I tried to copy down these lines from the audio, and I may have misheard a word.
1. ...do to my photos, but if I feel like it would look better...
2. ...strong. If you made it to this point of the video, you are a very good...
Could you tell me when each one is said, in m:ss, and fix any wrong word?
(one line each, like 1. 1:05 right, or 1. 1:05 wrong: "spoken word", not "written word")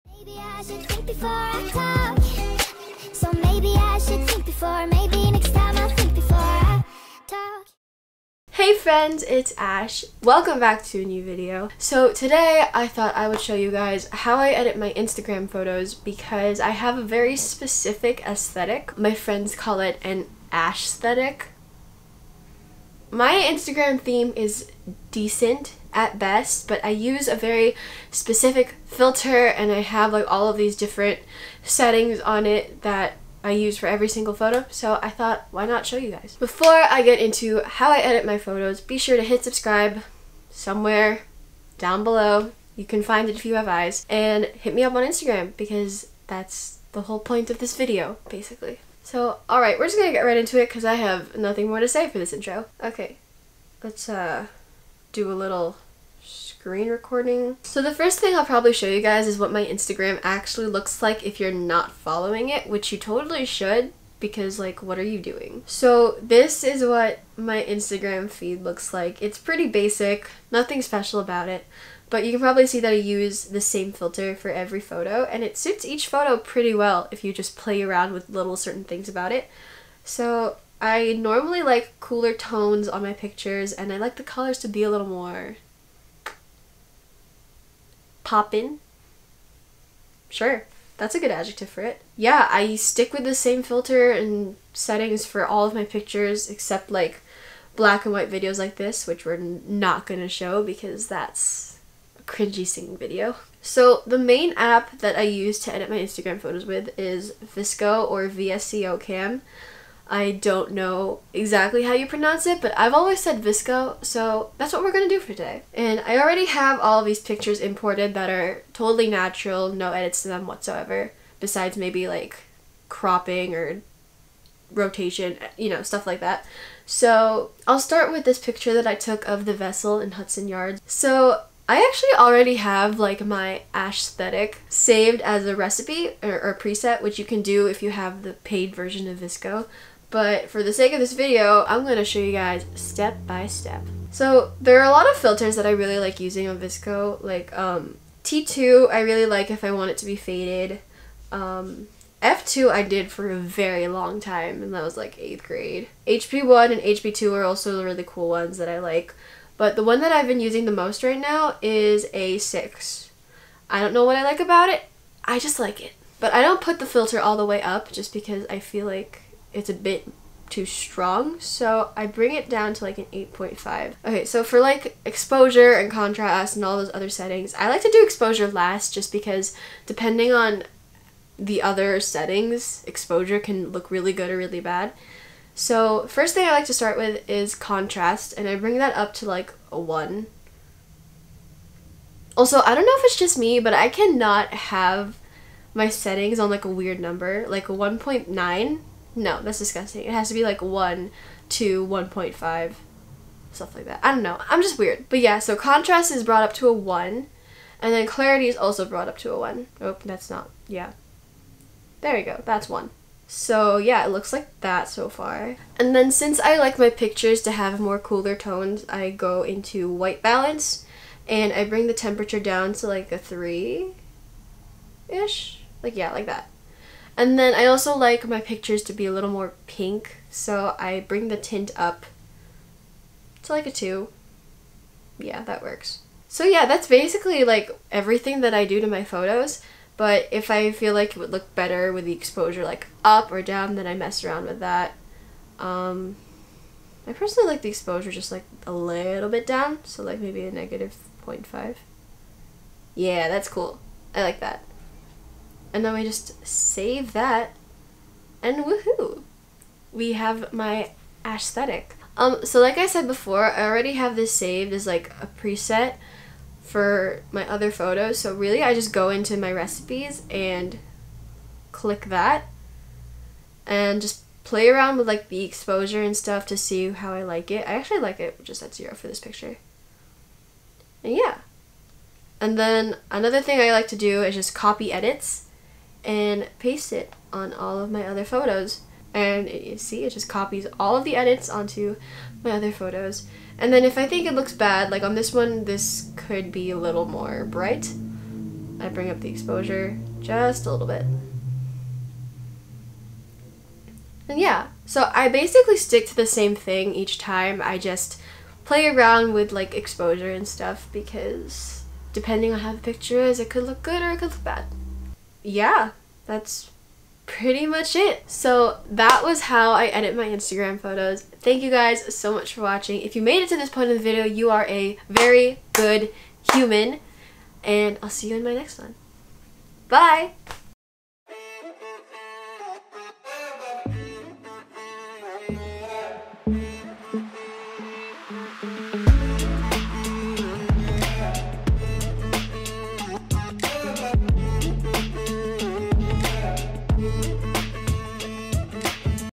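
1. 3:58 right
2. 5:22 wrong: "watching", not "strong".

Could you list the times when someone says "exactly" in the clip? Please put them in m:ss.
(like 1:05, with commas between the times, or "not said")
1:51.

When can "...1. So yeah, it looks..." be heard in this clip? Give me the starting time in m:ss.
3:32.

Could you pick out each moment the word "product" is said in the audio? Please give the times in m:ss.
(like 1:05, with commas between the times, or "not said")
not said.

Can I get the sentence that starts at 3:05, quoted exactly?
So first thing I like to start with is contrast, and I bring that up to like a 1.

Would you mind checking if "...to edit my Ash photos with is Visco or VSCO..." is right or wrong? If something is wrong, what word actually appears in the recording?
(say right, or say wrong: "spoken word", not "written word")
wrong: "Instagram", not "Ash".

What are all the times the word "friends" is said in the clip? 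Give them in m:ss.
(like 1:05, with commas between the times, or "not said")
0:08, 0:19.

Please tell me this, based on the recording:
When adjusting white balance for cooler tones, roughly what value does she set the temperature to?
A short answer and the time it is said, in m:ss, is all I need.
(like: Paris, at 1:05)
3, at 3:43.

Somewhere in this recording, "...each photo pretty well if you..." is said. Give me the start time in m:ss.
1:15.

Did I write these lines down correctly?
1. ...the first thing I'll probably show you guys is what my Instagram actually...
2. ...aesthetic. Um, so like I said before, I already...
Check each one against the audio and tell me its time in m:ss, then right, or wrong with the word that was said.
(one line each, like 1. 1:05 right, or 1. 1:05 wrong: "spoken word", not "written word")
1. 0:57 right
2. 4:21 right.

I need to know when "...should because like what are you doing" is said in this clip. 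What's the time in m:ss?
1:03.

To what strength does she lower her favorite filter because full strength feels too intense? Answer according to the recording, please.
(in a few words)
8.5.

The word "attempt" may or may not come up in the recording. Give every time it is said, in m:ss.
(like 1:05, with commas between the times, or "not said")
not said.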